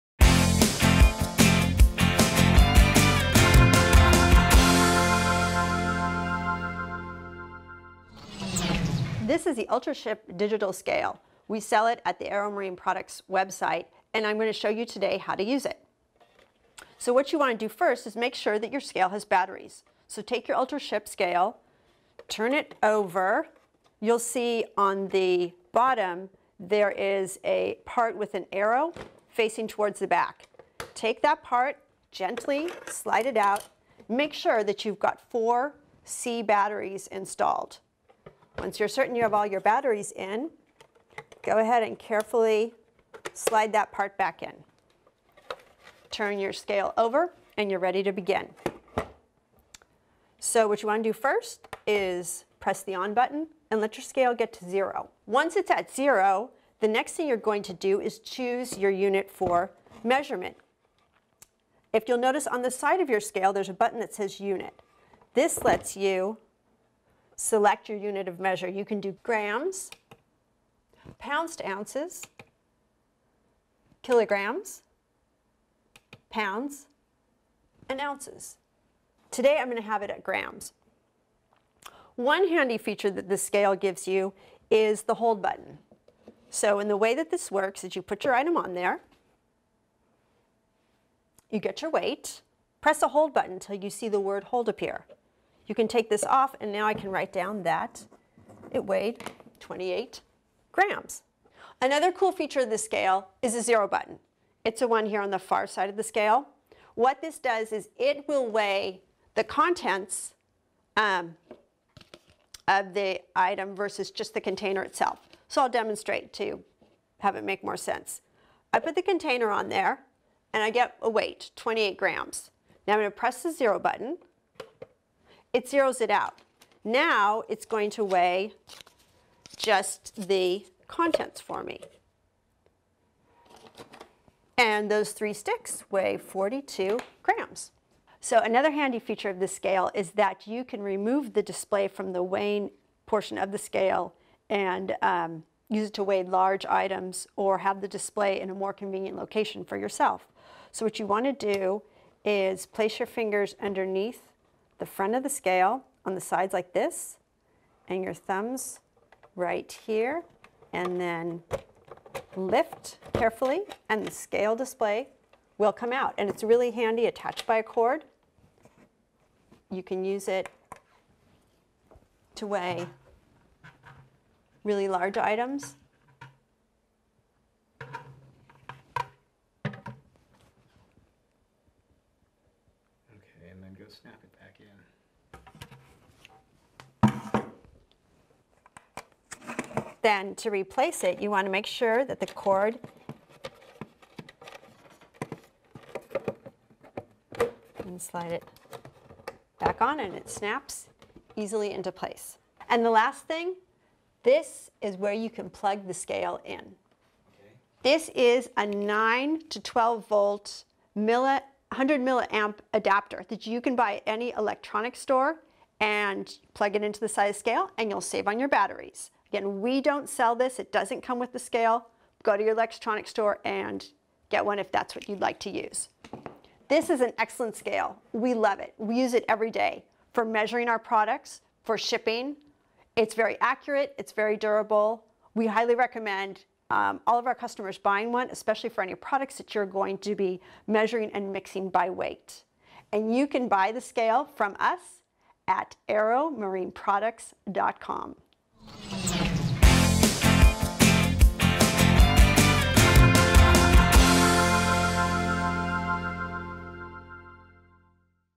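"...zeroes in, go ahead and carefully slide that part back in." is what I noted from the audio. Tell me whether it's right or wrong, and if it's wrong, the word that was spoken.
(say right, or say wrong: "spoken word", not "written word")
wrong: "batteries", not "zeroes".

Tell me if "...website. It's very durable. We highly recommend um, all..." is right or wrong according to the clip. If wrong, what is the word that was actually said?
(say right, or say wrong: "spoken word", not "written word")
wrong: "accurate", not "website".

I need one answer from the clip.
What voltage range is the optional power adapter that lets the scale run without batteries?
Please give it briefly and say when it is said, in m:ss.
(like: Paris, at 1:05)
9 to 12 volt, at 3:28.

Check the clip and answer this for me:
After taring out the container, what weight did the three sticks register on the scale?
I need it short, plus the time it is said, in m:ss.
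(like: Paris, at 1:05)
42 grams, at 2:16.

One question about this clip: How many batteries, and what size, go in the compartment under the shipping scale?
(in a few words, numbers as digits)
4 C batteries.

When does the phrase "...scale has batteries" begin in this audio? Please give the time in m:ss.
0:18.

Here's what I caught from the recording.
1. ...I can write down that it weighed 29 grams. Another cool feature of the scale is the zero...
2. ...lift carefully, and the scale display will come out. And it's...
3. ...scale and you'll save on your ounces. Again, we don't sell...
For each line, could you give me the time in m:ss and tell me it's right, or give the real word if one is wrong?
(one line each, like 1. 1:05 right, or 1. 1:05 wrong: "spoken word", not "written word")
1. 1:36 wrong: "28", not "29"
2. 2:42 right
3. 3:37 wrong: "batteries", not "ounces".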